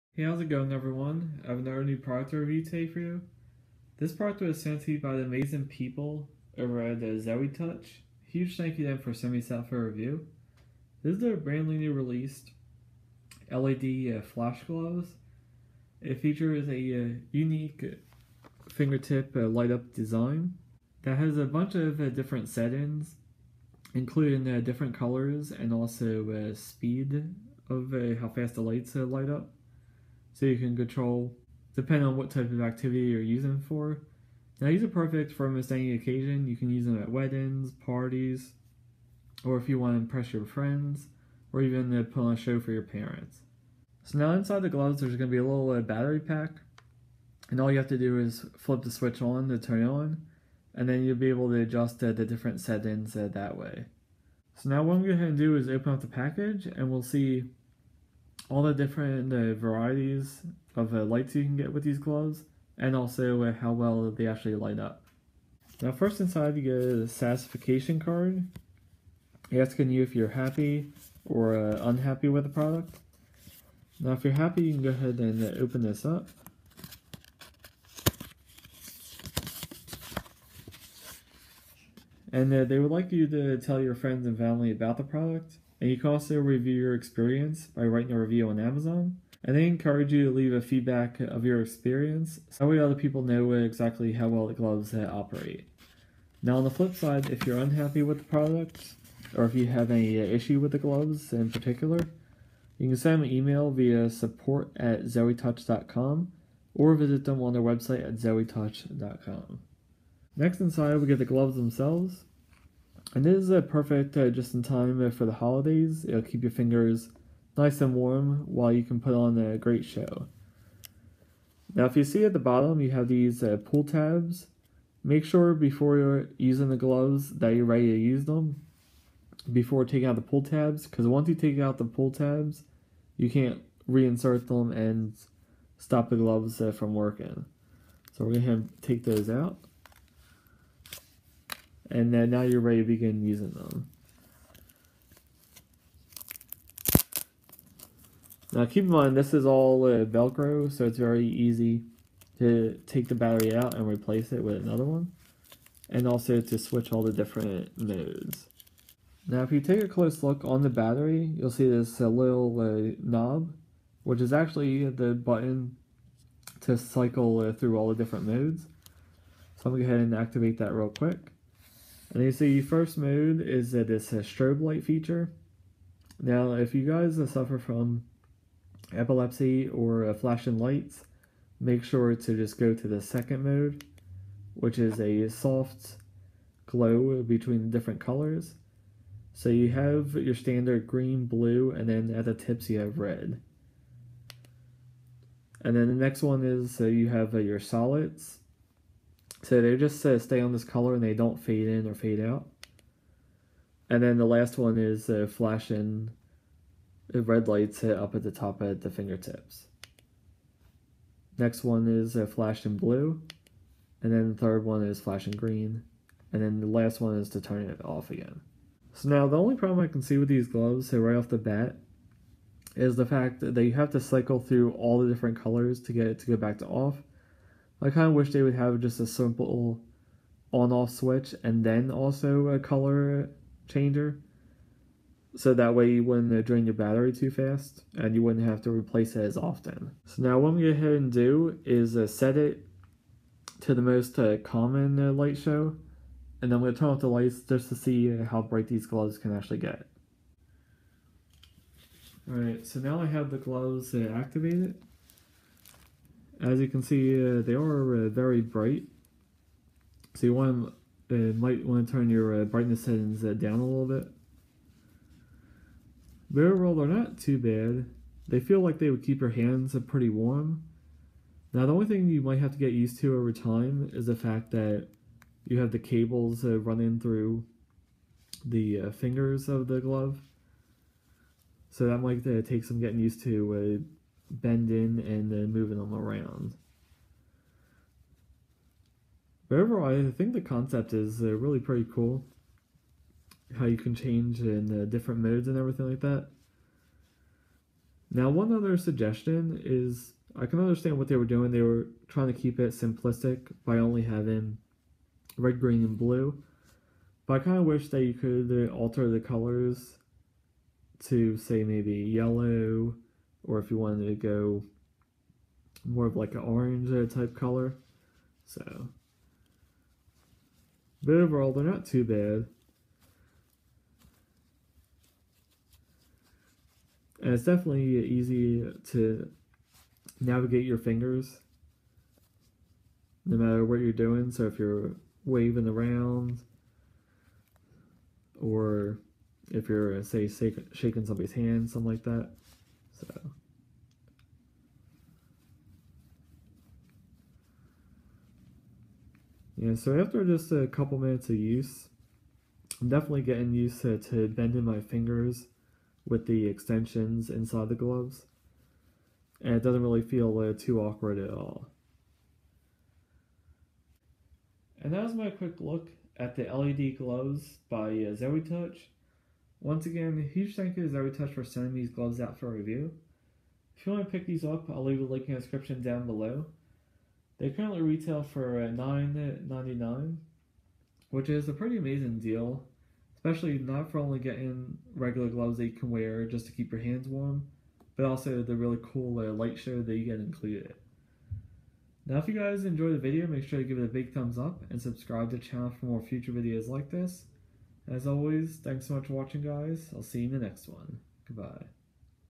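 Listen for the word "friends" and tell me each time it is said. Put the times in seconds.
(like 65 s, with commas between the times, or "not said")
40 s, 83 s.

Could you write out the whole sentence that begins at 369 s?
Once again, a huge thank you to Zoetouch for sending these gloves out for review.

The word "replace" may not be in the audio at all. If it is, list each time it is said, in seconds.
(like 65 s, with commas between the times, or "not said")
153 s, 238 s.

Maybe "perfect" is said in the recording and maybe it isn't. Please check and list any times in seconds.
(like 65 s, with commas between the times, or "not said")
34 s, 113 s.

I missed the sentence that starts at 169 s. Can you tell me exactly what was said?
So I'm going to go ahead and activate that real quick.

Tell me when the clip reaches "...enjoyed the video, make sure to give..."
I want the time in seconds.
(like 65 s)
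392 s.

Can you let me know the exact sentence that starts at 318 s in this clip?
So, but overall, they're not too bad.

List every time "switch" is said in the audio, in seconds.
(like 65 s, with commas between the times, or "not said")
48 s, 156 s, 230 s.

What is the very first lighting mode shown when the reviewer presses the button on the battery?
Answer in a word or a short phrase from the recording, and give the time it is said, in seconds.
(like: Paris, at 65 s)
strobe light, at 174 s.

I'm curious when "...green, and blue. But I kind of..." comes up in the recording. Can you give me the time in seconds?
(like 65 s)
305 s.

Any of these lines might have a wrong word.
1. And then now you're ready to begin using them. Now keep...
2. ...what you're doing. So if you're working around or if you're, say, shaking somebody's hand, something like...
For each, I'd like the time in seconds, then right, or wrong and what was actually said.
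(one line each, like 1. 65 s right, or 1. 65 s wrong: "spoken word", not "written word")
1. 141 s right
2. 333 s wrong: "waving", not "working".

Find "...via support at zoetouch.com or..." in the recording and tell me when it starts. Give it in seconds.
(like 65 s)
103 s.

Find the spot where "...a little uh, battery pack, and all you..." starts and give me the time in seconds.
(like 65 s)
45 s.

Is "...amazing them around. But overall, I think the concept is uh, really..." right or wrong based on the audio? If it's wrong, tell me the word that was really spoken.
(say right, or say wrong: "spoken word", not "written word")
wrong: "moving", not "amazing".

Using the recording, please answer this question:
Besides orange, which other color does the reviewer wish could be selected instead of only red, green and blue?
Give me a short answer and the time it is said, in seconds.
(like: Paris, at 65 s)
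yellow, at 311 s.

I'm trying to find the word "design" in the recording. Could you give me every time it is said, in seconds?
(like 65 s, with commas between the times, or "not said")
19 s.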